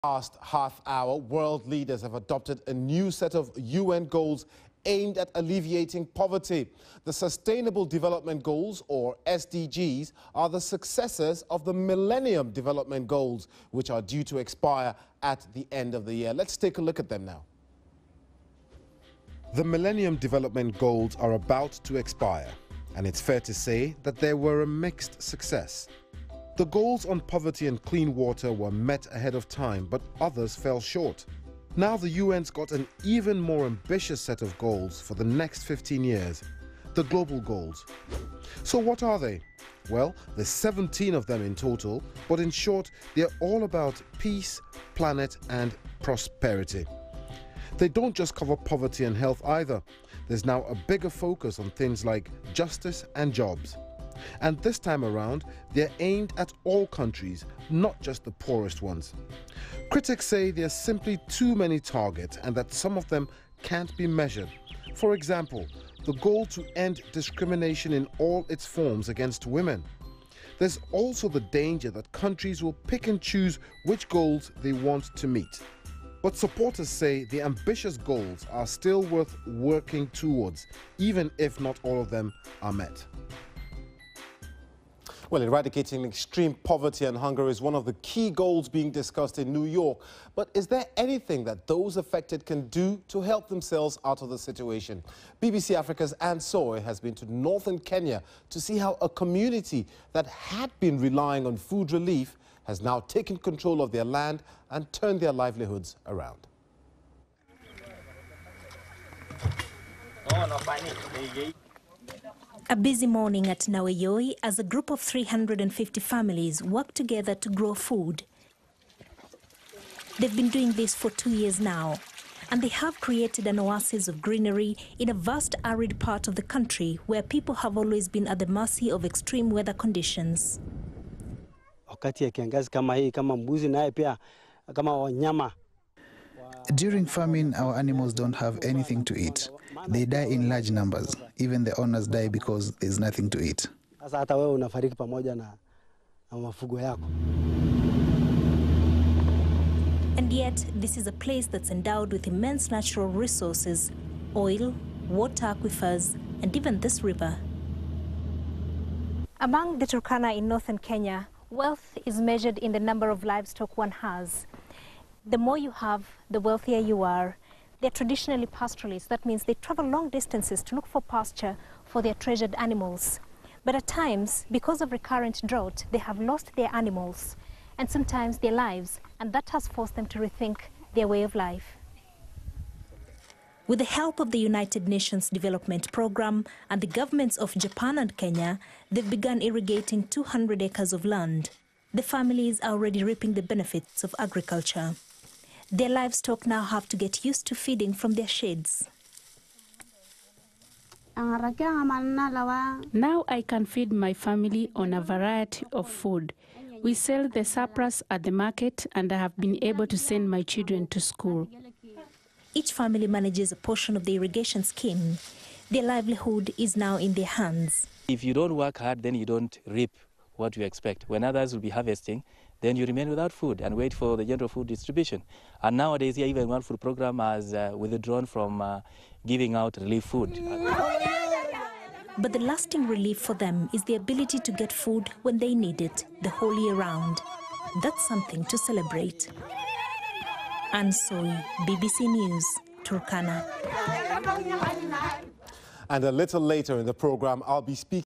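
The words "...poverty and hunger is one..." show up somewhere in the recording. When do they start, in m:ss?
1:26.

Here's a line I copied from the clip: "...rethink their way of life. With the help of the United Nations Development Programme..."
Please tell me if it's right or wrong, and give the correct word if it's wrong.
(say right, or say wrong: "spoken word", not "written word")
right.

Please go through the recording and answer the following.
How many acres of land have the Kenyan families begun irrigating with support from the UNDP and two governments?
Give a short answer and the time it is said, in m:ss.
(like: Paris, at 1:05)
200, at 3:10.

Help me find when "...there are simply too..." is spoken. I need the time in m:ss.
1:00.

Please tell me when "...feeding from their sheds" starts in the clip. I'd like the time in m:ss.
3:17.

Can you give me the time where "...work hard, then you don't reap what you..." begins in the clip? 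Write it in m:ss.
3:38.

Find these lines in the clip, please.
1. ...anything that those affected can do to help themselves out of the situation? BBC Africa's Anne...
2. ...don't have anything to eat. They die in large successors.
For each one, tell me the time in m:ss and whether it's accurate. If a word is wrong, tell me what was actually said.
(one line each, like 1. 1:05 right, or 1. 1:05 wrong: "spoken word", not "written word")
1. 1:30 right
2. 2:18 wrong: "numbers", not "successors".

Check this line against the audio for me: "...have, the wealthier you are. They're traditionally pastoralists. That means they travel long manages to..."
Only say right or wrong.
wrong.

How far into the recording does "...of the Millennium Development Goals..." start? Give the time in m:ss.
0:11.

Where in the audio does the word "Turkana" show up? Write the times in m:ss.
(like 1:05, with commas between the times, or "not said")
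2:39, 4:02.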